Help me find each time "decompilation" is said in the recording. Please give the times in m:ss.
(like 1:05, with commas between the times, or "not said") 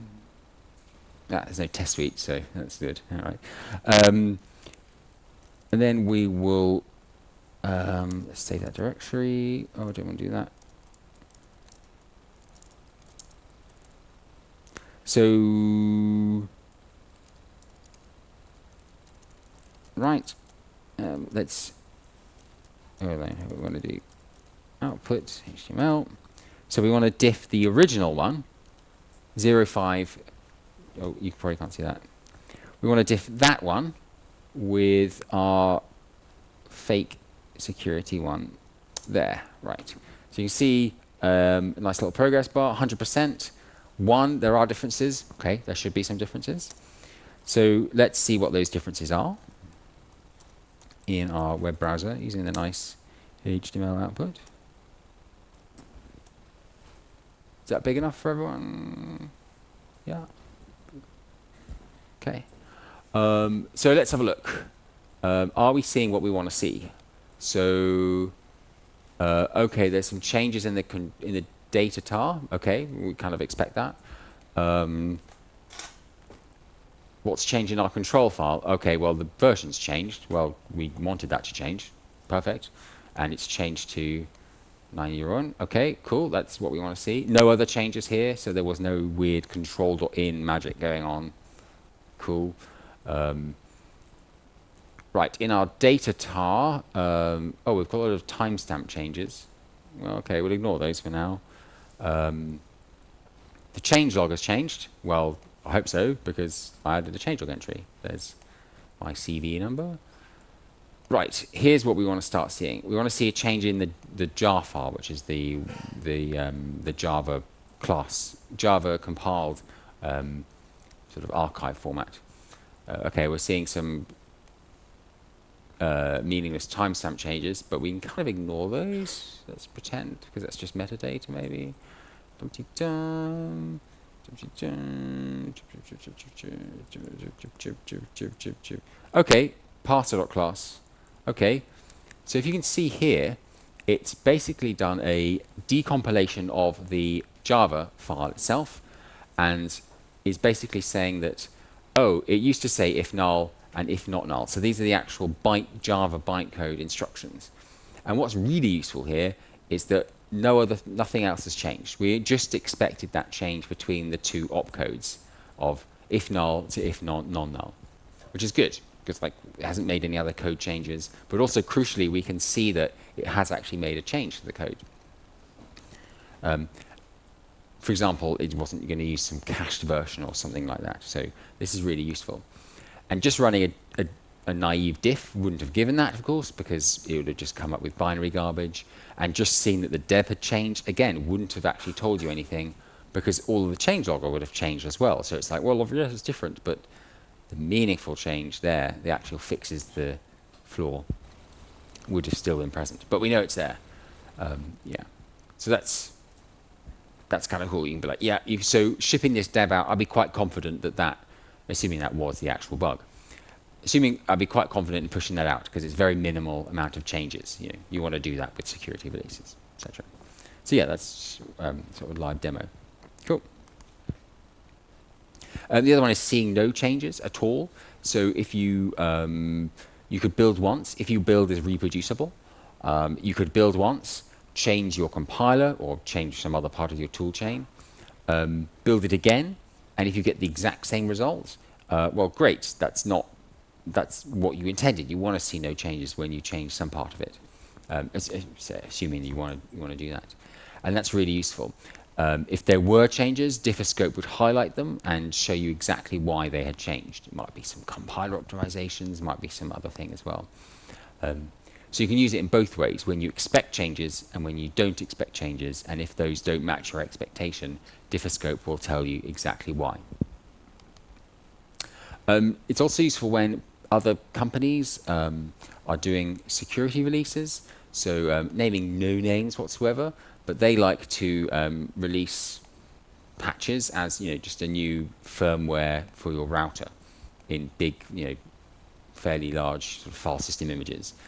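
2:25.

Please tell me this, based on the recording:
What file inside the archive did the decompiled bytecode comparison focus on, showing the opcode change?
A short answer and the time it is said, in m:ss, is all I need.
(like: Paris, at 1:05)
parser.class, at 2:19.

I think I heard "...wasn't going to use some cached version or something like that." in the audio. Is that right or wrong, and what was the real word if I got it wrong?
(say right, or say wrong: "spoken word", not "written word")
right.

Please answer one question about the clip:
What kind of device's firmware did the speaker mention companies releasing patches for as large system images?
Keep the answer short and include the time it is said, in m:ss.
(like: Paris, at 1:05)
router, at 4:46.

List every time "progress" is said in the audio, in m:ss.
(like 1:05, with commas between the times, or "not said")
0:42.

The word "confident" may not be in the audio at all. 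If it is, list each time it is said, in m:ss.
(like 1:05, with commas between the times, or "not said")
3:30, 3:34.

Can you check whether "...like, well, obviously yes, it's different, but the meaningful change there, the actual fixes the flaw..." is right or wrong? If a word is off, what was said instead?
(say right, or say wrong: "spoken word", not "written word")
right.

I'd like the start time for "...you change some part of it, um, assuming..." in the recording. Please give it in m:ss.
4:06.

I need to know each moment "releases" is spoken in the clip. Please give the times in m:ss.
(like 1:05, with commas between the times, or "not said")
3:39, 4:37, 4:41.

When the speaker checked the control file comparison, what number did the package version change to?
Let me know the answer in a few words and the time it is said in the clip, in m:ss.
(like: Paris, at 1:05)
9, at 1:24.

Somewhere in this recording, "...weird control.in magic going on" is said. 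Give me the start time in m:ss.
1:29.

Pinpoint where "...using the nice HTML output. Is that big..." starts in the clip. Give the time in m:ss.
0:52.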